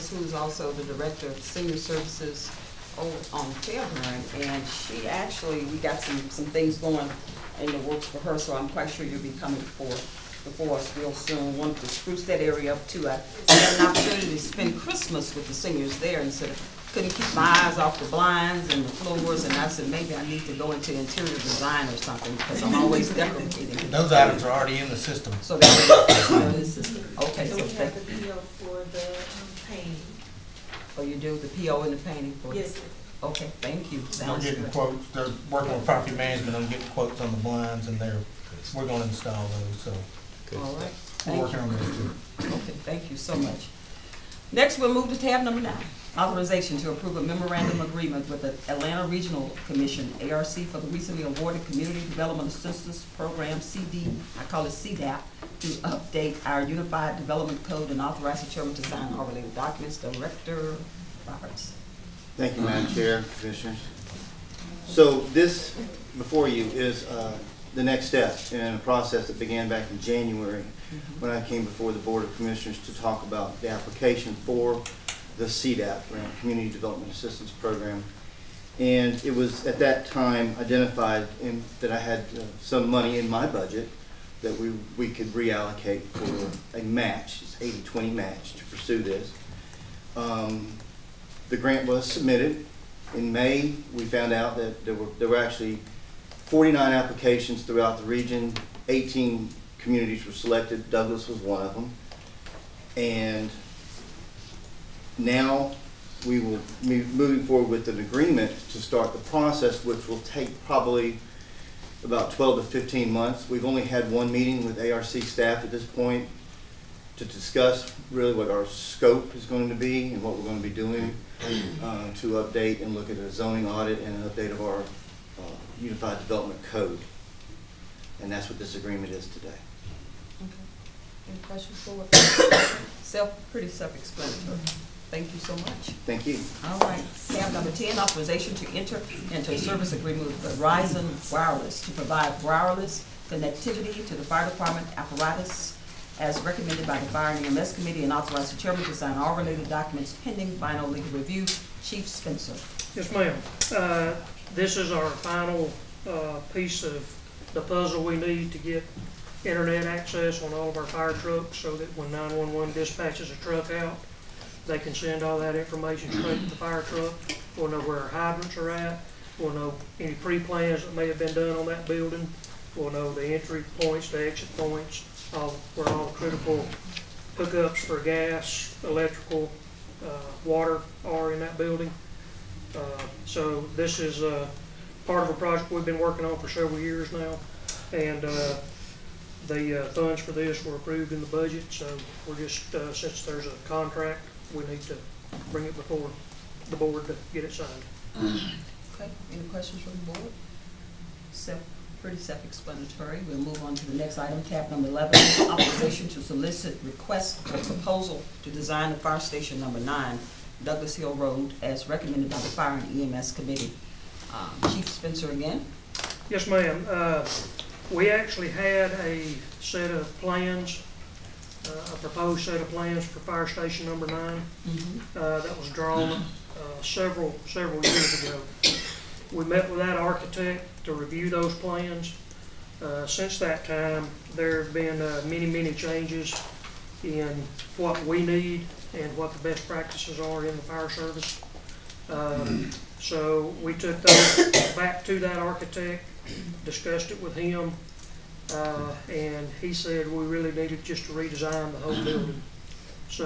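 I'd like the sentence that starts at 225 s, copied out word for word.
uh, that was drawn uh, several several years ago.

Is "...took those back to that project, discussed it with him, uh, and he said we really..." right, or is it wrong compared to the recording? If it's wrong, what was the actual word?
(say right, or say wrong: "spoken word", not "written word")
wrong: "architect", not "project".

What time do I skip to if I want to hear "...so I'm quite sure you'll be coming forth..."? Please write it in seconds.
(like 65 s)
8 s.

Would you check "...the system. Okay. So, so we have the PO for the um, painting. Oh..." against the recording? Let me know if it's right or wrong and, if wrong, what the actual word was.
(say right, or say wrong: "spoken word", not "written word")
right.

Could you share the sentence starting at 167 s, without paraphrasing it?
We'll know where our hydrants are at.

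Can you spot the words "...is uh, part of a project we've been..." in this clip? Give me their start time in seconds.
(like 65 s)
183 s.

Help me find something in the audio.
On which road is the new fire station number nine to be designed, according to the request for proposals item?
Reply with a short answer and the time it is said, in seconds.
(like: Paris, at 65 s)
Douglas Hill Road, at 210 s.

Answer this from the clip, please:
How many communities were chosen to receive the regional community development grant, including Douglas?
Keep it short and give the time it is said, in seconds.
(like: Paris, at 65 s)
18, at 98 s.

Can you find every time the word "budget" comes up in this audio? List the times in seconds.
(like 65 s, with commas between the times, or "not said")
83 s, 191 s.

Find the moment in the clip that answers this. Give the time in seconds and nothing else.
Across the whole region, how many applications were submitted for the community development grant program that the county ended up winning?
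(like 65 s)
96 s.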